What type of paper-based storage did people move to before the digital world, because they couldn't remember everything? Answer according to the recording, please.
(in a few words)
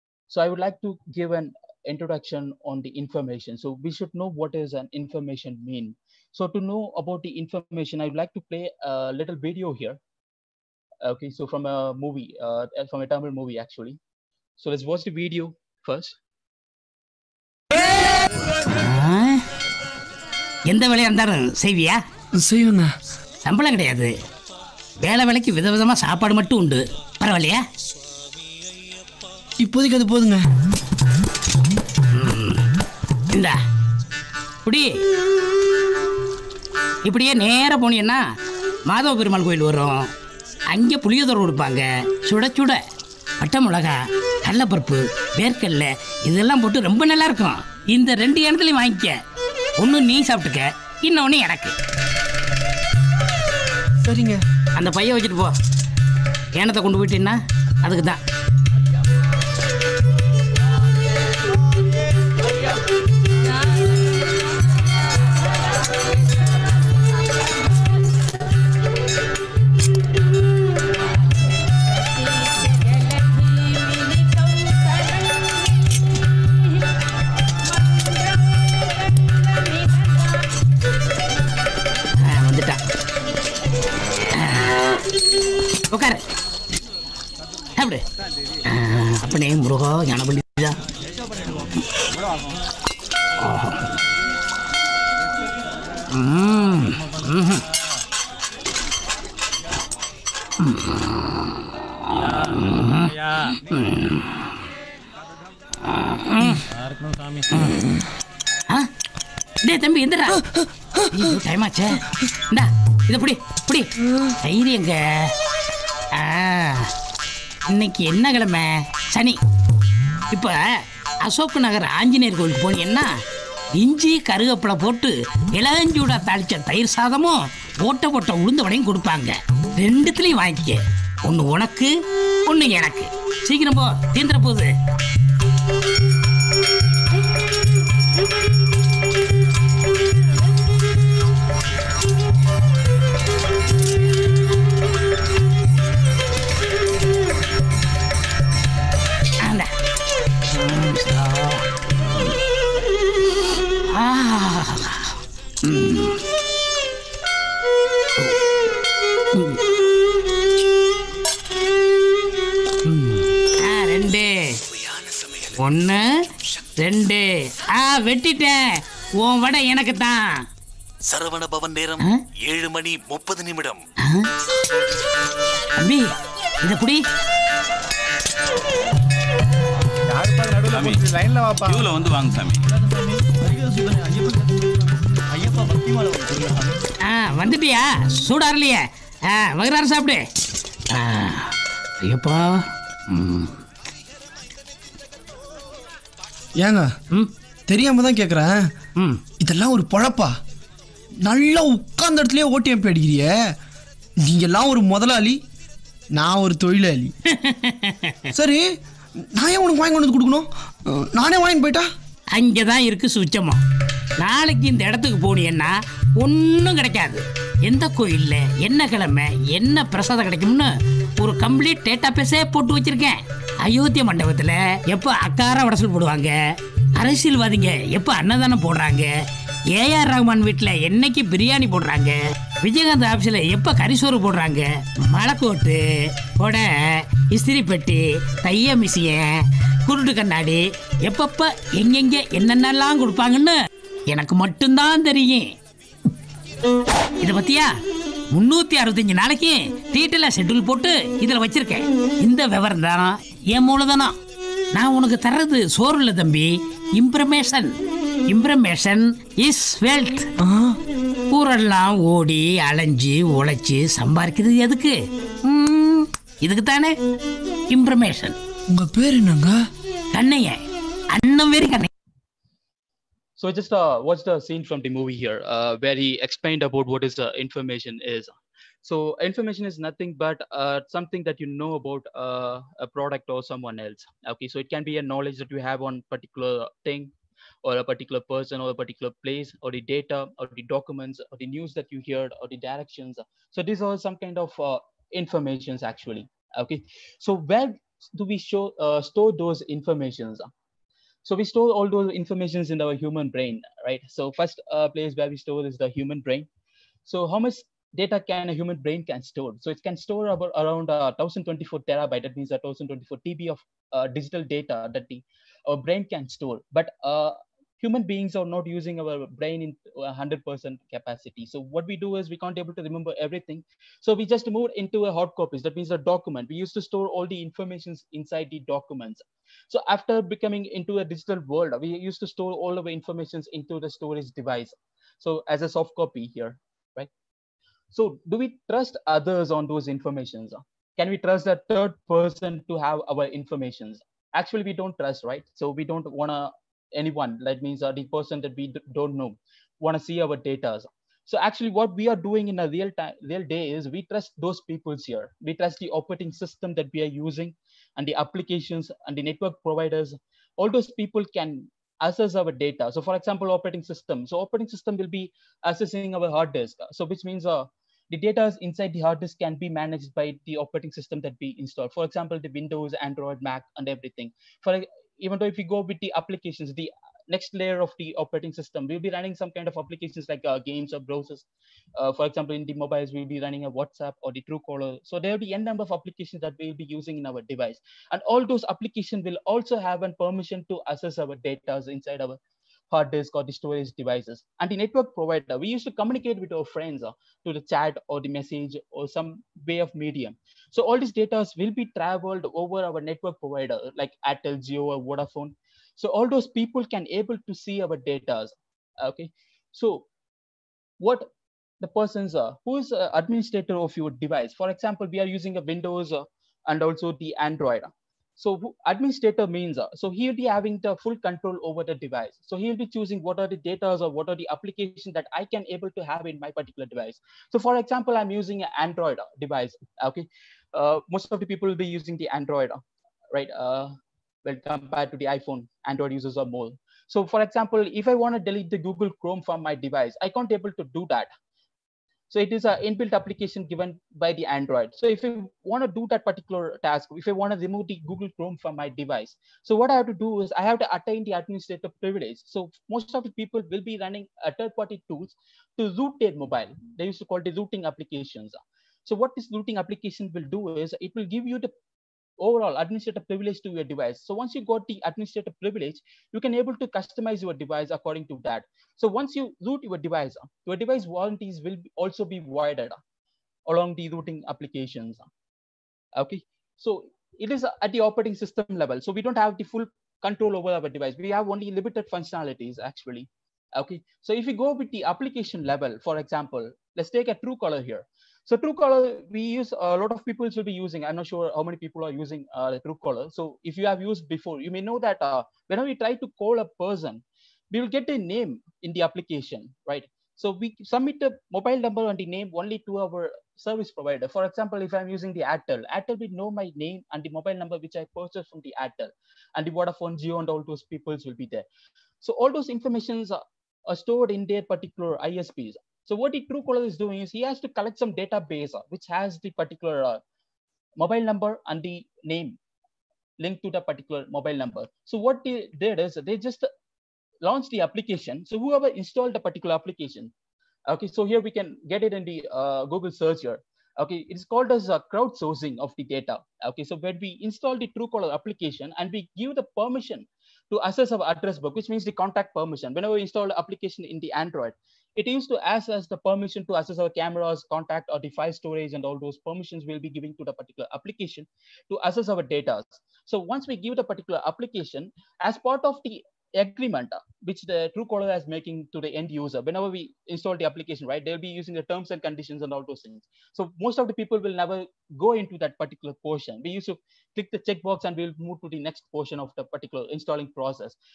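Hard copies.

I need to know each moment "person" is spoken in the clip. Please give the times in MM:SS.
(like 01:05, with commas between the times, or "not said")
04:48, 05:42, 05:48, 06:51, 08:16.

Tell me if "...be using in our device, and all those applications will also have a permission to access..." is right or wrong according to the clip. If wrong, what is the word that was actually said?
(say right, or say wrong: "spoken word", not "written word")
right.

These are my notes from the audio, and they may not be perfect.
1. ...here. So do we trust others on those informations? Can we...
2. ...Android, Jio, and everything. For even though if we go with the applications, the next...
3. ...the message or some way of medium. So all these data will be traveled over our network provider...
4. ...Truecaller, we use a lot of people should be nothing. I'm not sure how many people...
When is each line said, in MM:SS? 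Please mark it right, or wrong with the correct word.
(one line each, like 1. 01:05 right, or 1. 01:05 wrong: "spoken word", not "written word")
1. 05:36 right
2. 06:12 wrong: "Mac", not "Jio"
3. 06:38 right
4. 08:08 wrong: "using", not "nothing".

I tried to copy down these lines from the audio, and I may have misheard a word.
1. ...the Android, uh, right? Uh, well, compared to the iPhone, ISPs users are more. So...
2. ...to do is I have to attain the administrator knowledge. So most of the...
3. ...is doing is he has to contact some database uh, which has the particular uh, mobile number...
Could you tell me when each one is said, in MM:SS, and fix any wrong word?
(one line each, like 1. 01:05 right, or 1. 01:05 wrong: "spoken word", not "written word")
1. 07:12 wrong: "Android", not "ISPs"
2. 07:30 wrong: "privilege", not "knowledge"
3. 08:36 wrong: "collect", not "contact".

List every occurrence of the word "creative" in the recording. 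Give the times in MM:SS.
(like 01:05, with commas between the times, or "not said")
not said.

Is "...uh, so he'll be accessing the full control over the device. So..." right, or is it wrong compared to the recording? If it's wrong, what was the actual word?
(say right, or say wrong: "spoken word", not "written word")
wrong: "having", not "accessing".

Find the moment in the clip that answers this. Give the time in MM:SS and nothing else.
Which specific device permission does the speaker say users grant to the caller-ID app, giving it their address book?
09:02.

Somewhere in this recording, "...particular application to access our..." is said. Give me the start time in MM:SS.
09:10.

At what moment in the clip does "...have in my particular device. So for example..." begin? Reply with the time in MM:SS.
07:06.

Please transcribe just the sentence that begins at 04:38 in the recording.
So information is nothing but uh, something that you know about uh, a product or someone else.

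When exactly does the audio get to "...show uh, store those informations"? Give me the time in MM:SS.
04:58.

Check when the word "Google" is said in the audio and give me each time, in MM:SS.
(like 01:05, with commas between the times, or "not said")
07:18, 07:28, 08:52.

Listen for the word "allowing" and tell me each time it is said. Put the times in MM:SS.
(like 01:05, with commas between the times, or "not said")
not said.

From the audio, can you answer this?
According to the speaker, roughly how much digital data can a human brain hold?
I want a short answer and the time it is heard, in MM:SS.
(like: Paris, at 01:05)
1024 terabytes, at 05:11.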